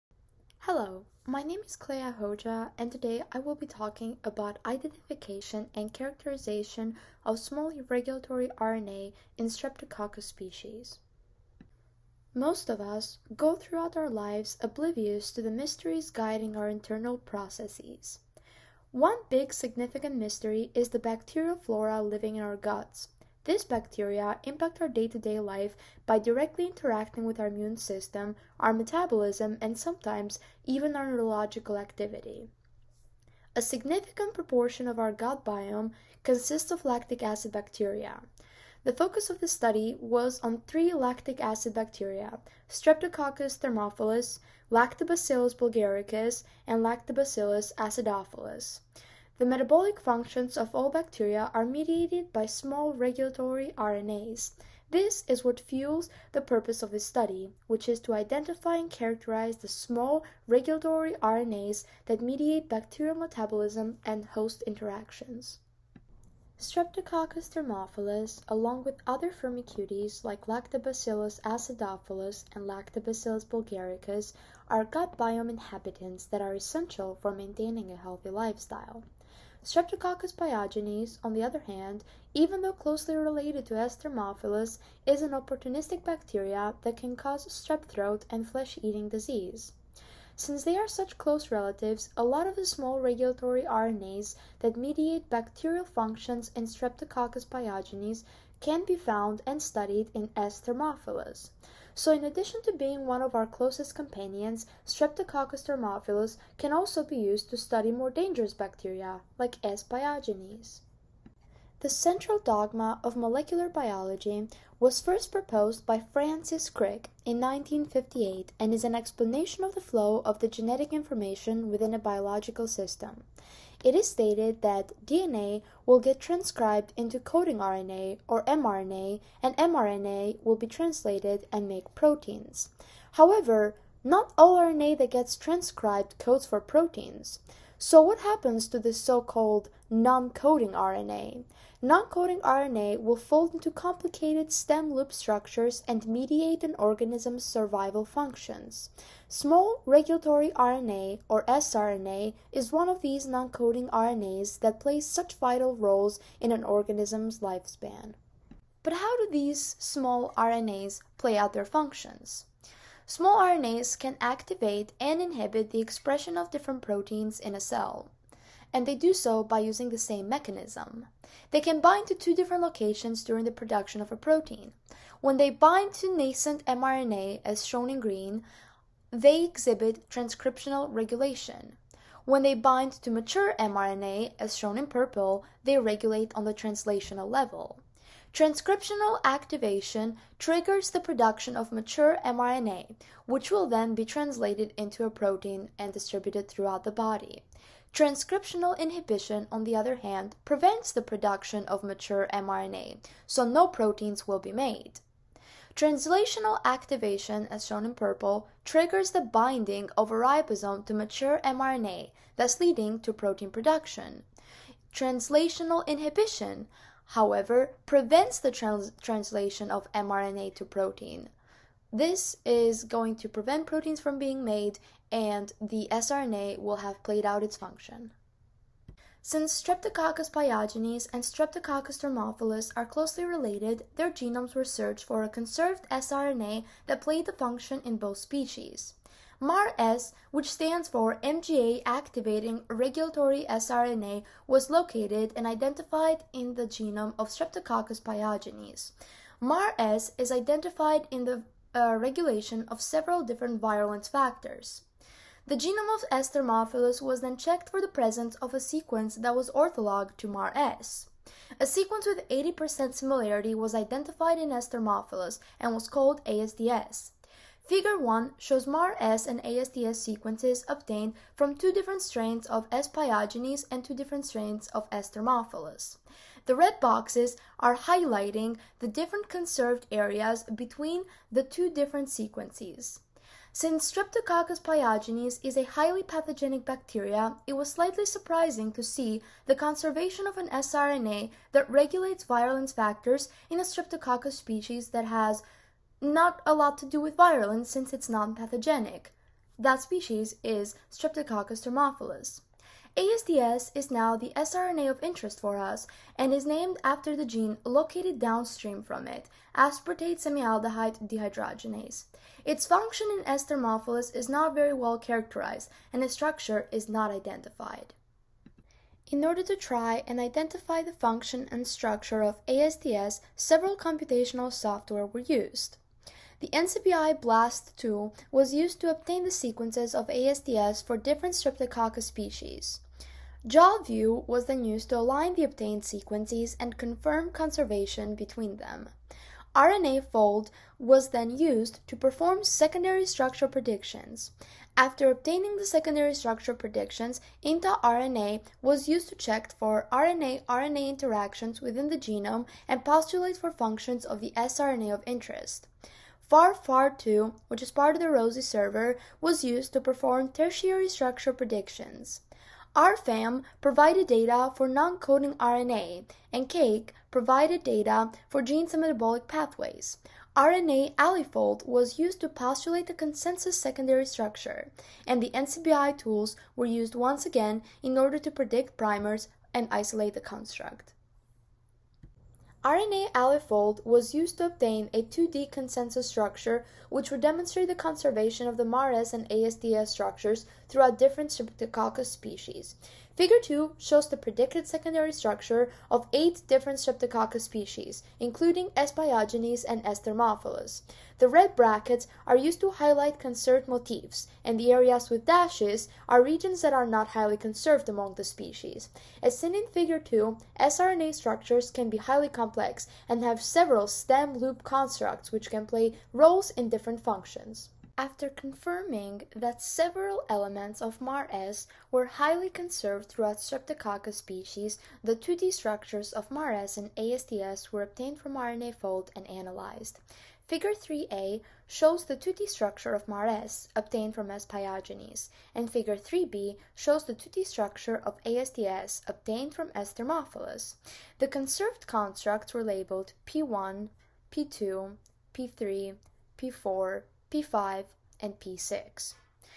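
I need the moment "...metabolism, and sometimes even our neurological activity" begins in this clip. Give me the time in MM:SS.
00:28.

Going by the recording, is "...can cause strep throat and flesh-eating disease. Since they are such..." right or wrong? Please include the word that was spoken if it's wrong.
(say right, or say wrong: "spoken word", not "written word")
right.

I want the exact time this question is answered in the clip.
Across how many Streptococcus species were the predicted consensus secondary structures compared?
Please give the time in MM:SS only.
06:36.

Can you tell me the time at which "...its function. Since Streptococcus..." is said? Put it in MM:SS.
03:47.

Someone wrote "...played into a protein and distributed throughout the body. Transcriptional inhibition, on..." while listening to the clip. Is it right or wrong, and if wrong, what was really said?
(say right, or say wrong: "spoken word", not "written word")
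wrong: "translated", not "played".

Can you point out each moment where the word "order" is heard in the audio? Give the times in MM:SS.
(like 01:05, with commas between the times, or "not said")
05:19, 06:17.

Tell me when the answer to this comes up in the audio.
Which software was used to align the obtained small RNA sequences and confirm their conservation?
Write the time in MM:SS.
05:33.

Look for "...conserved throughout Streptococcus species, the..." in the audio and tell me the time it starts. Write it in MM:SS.
07:02.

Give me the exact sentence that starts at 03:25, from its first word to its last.
Translational activation, as shown in purple, triggers the binding of a ribosome to mature mRNA, thus leading to protein production.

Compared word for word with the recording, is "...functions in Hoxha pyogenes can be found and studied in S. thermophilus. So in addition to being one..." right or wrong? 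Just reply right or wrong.
wrong.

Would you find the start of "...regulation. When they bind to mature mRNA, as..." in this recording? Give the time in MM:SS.
03:00.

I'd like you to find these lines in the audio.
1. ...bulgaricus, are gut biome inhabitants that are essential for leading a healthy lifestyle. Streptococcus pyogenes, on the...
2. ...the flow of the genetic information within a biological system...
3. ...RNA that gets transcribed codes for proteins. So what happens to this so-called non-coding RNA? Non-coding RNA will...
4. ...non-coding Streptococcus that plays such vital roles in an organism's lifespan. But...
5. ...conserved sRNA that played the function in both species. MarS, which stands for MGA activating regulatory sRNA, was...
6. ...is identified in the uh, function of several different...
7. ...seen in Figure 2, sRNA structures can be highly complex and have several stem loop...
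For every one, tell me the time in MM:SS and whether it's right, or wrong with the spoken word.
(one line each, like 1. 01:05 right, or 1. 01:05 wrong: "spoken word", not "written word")
1. 01:13 wrong: "maintaining", not "leading"
2. 01:59 right
3. 02:14 right
4. 02:33 wrong: "RNAs", not "Streptococcus"
5. 03:55 right
6. 04:10 wrong: "regulation", not "function"
7. 06:49 right.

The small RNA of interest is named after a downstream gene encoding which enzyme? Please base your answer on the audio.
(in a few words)
aspartate semialdehyde dehydrogenase.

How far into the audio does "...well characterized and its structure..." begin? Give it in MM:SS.
05:14.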